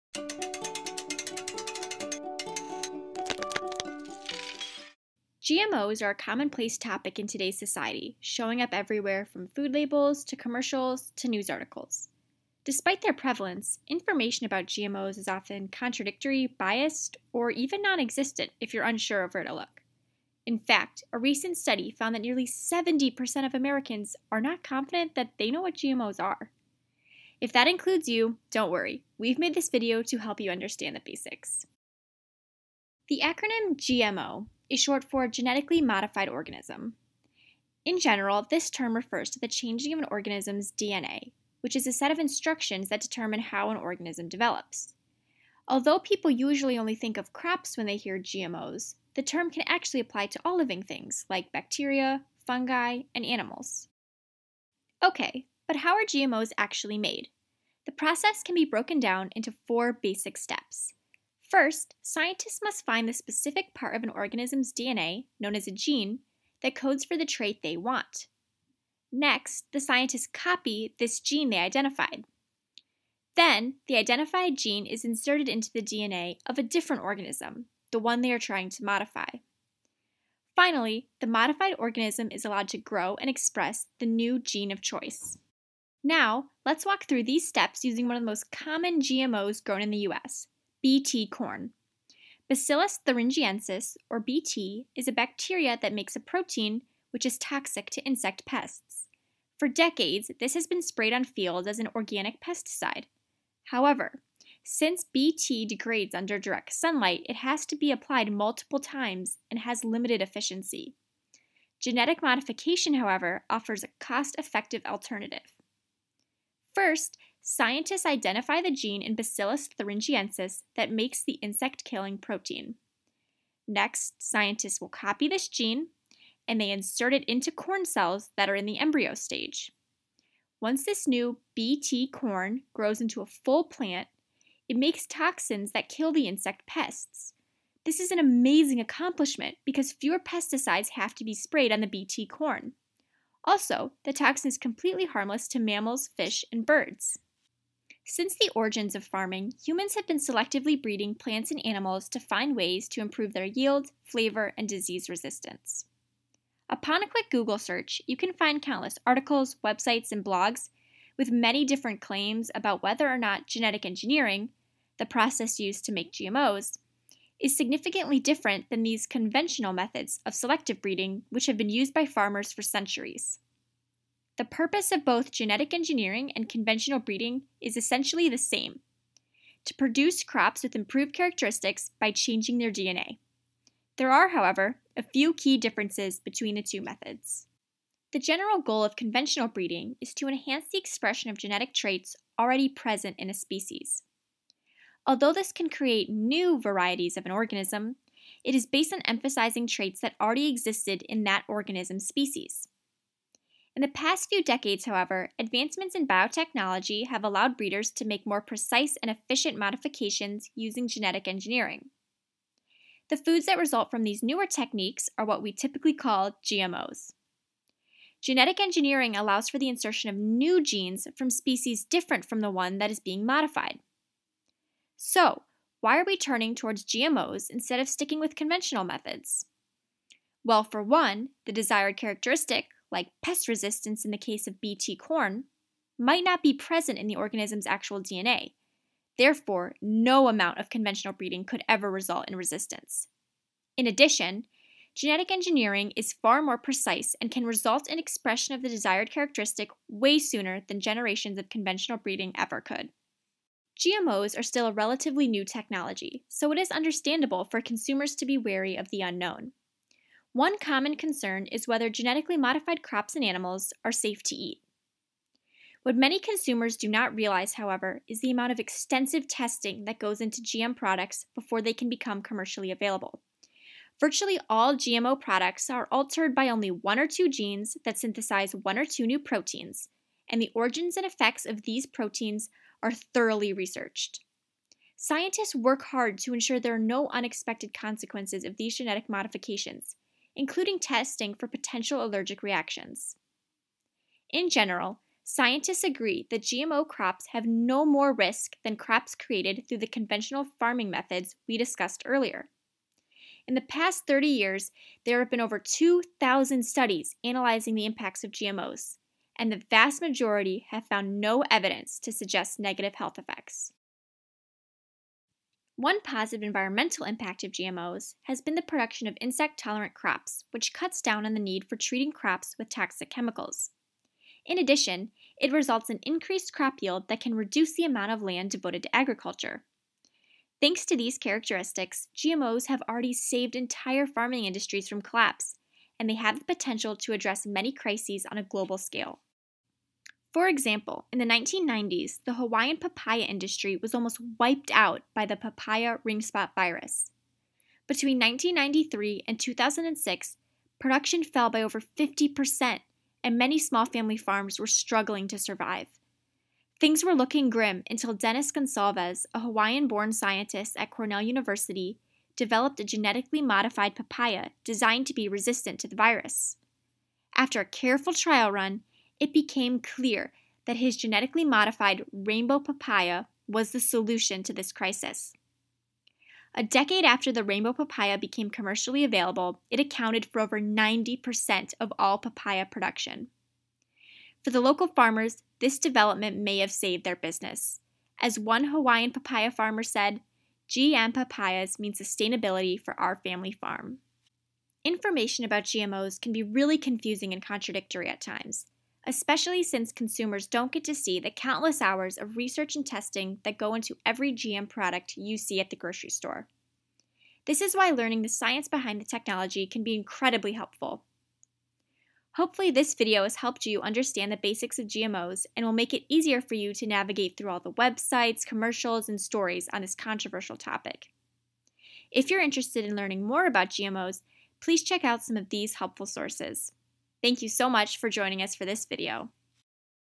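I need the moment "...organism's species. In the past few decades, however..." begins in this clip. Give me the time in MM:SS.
03:21.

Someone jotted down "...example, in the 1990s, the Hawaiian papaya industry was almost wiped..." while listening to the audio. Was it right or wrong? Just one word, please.
right.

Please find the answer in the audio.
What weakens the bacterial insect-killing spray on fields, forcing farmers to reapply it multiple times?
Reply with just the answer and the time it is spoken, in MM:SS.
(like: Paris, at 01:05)
direct sunlight, at 01:46.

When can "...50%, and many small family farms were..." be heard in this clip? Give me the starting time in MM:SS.
05:51.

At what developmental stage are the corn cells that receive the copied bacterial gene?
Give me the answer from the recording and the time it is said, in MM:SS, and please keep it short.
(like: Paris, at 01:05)
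embryo stage, at 02:08.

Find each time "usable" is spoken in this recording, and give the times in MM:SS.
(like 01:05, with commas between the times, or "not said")
not said.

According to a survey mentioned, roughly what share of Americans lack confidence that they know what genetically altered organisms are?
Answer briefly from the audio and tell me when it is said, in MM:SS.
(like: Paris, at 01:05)
70%, at 00:22.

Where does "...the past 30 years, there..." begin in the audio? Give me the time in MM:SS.
05:03.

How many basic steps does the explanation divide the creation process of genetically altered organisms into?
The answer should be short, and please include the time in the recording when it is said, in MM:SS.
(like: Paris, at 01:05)
4, at 00:59.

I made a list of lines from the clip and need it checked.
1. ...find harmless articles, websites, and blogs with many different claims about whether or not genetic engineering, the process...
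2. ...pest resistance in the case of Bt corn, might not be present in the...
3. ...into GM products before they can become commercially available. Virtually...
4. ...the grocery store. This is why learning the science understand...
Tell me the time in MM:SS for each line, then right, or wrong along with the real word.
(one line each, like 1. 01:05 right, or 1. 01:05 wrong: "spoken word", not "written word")
1. 02:38 wrong: "countless", not "harmless"
2. 03:53 right
3. 04:30 right
4. 06:45 wrong: "behind", not "understand".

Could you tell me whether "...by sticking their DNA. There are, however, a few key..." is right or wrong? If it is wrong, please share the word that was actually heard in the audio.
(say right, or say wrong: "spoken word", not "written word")
wrong: "changing", not "sticking".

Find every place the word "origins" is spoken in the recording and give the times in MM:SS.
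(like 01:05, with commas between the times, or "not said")
02:28, 04:40.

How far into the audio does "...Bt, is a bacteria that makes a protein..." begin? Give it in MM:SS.
01:34.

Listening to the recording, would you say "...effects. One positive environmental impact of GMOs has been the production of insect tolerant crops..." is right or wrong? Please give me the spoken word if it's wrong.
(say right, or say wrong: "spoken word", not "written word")
right.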